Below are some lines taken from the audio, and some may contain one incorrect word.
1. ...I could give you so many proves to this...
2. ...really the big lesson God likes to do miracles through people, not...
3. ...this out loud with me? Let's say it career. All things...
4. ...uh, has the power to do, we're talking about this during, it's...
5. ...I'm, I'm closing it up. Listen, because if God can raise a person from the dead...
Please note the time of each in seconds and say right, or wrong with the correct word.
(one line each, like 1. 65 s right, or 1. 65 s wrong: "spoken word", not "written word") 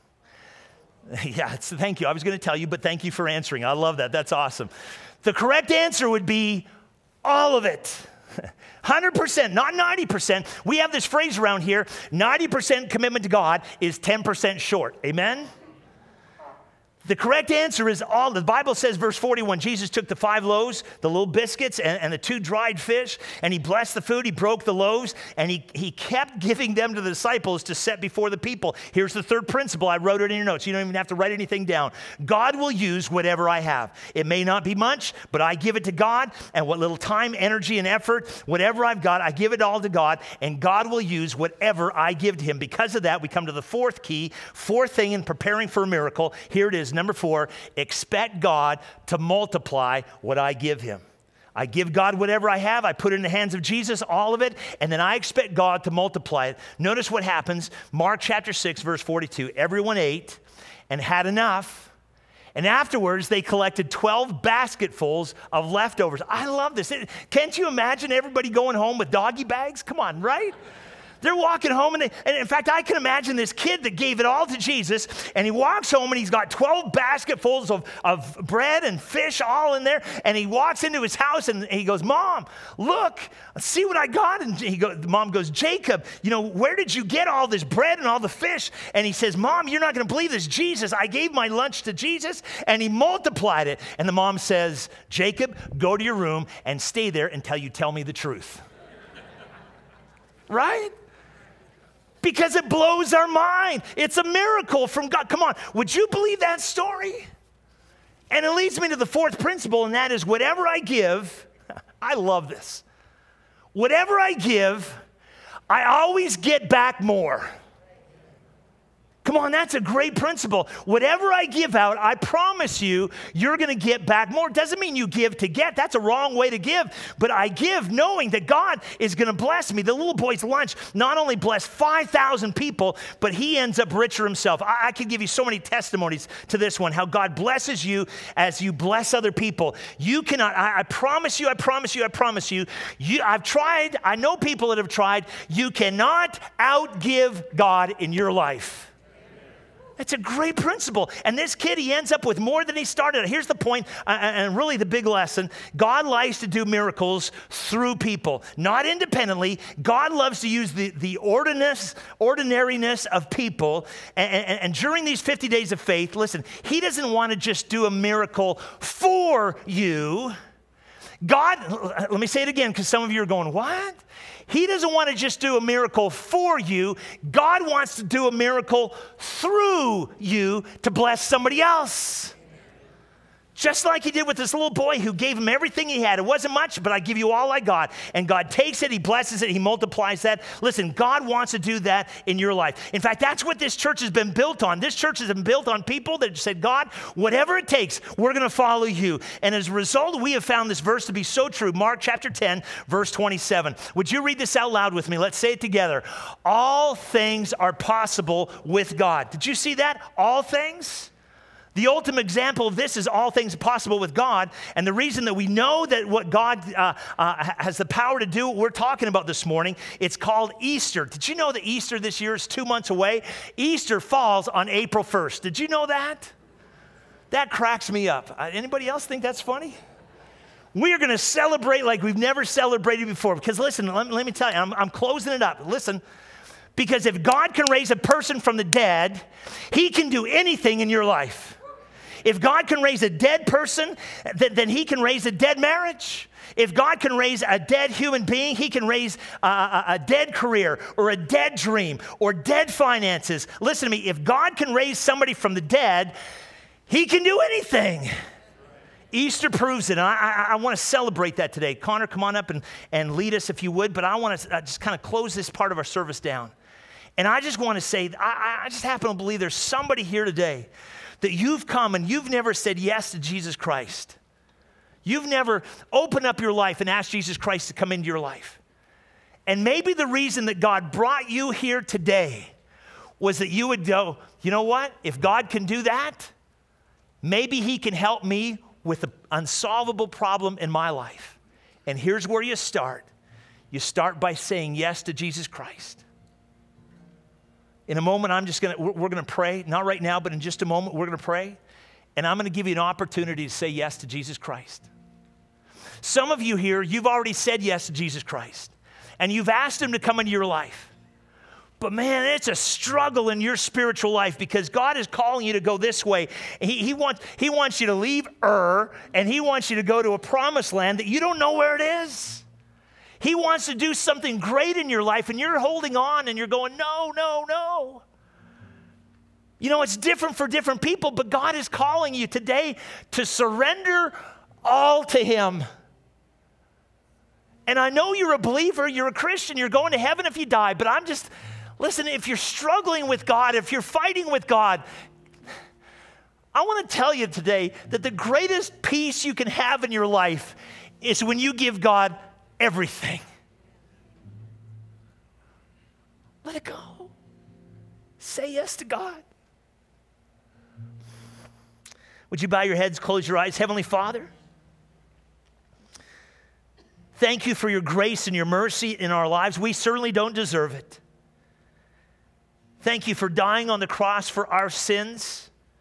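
1. 134 s wrong: "testimonies", not "proves"
2. 154 s right
3. 204 s wrong: "together", not "career"
4. 217 s wrong: "morning", not "during"
5. 234 s right.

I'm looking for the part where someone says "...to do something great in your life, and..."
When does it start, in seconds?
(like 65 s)
323 s.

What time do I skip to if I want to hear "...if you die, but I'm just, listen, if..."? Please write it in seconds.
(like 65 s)
340 s.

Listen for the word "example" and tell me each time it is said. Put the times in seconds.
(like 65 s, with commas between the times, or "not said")
212 s.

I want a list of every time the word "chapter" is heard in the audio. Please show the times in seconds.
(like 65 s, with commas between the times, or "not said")
58 s, 202 s.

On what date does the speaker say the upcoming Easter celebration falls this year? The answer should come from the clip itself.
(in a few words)
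April 1st.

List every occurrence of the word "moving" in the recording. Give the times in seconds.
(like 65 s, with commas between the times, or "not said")
not said.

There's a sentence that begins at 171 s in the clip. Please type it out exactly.
God, let me say it again because some of you are going, What?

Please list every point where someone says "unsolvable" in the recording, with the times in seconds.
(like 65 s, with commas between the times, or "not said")
289 s.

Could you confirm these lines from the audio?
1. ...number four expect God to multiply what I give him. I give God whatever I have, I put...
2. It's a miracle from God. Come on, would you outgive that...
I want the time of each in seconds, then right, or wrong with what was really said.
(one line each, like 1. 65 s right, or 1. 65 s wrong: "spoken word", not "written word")
1. 46 s right
2. 103 s wrong: "believe", not "outgive".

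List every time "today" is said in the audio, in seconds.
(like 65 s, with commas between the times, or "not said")
261 s, 270 s, 281 s, 332 s, 347 s.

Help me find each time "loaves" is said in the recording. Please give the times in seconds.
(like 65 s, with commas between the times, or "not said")
20 s, 24 s.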